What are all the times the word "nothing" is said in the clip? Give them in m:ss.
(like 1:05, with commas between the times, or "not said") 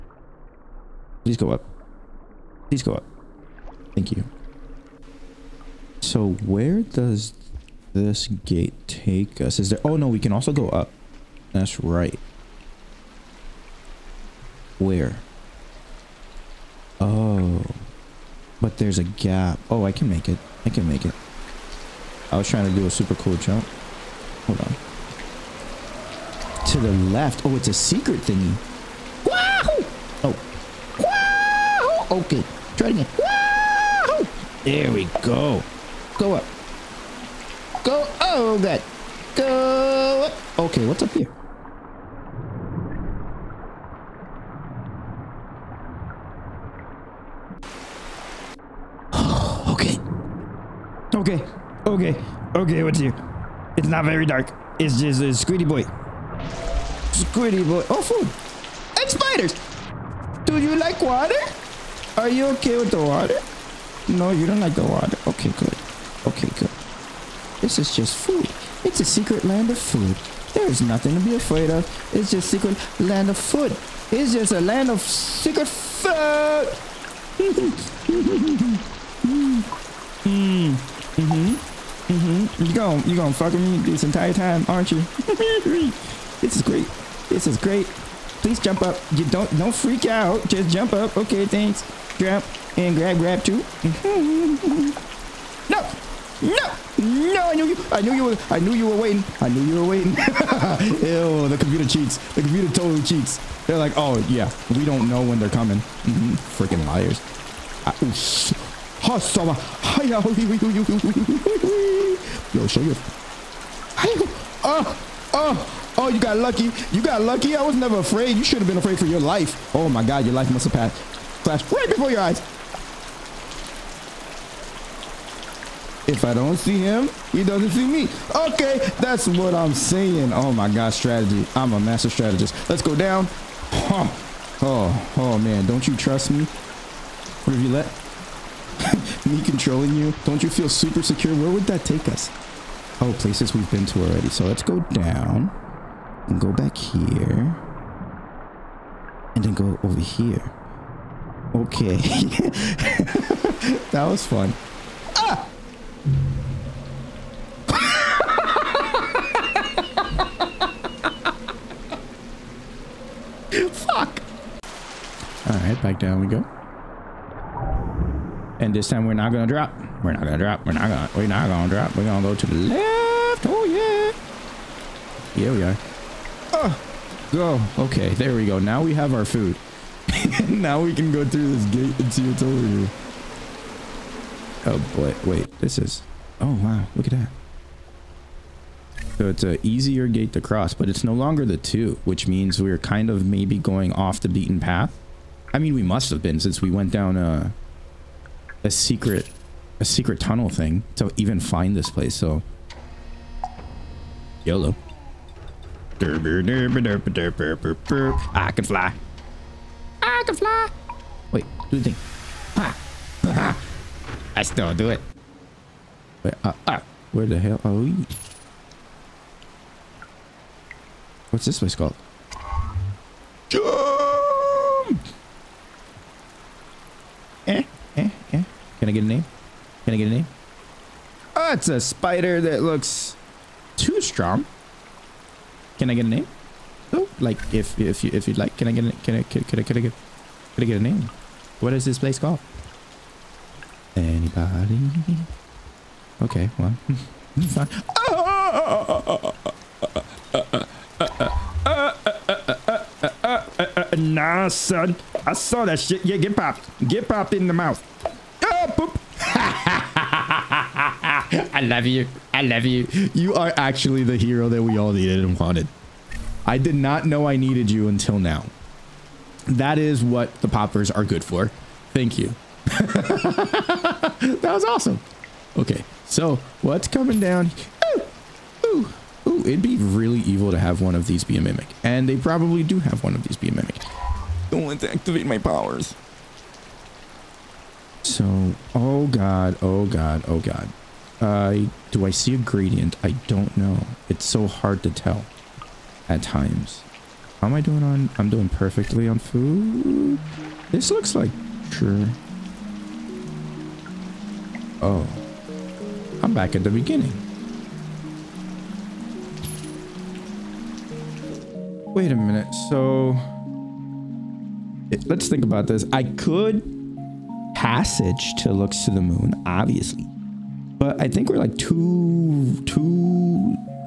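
1:10.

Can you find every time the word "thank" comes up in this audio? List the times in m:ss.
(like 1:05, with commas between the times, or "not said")
0:03, 1:31, 4:31.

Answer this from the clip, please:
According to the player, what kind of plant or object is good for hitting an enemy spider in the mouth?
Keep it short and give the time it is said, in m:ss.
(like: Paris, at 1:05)
poppers, at 4:30.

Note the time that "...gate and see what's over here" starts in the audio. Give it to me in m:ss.
3:01.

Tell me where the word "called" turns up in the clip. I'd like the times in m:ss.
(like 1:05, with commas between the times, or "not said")
3:41, 4:02.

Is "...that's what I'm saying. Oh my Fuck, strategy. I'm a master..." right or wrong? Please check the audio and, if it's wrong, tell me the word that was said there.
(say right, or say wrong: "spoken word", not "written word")
wrong: "God", not "Fuck".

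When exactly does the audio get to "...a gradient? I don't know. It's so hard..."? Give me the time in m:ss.
4:52.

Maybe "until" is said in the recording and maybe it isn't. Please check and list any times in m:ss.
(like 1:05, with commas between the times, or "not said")
4:27.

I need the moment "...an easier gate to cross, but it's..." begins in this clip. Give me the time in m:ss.
3:09.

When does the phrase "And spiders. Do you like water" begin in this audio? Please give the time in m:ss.
0:59.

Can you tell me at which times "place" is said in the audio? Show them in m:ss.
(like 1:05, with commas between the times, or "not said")
2:23, 3:21, 3:41, 4:01.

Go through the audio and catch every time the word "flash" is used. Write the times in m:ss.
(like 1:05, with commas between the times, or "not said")
2:01.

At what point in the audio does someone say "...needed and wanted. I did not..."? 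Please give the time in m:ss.
4:24.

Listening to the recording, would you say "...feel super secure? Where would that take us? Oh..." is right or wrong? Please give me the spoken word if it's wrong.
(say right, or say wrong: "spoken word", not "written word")
right.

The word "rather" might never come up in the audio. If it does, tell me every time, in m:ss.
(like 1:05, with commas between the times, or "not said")
not said.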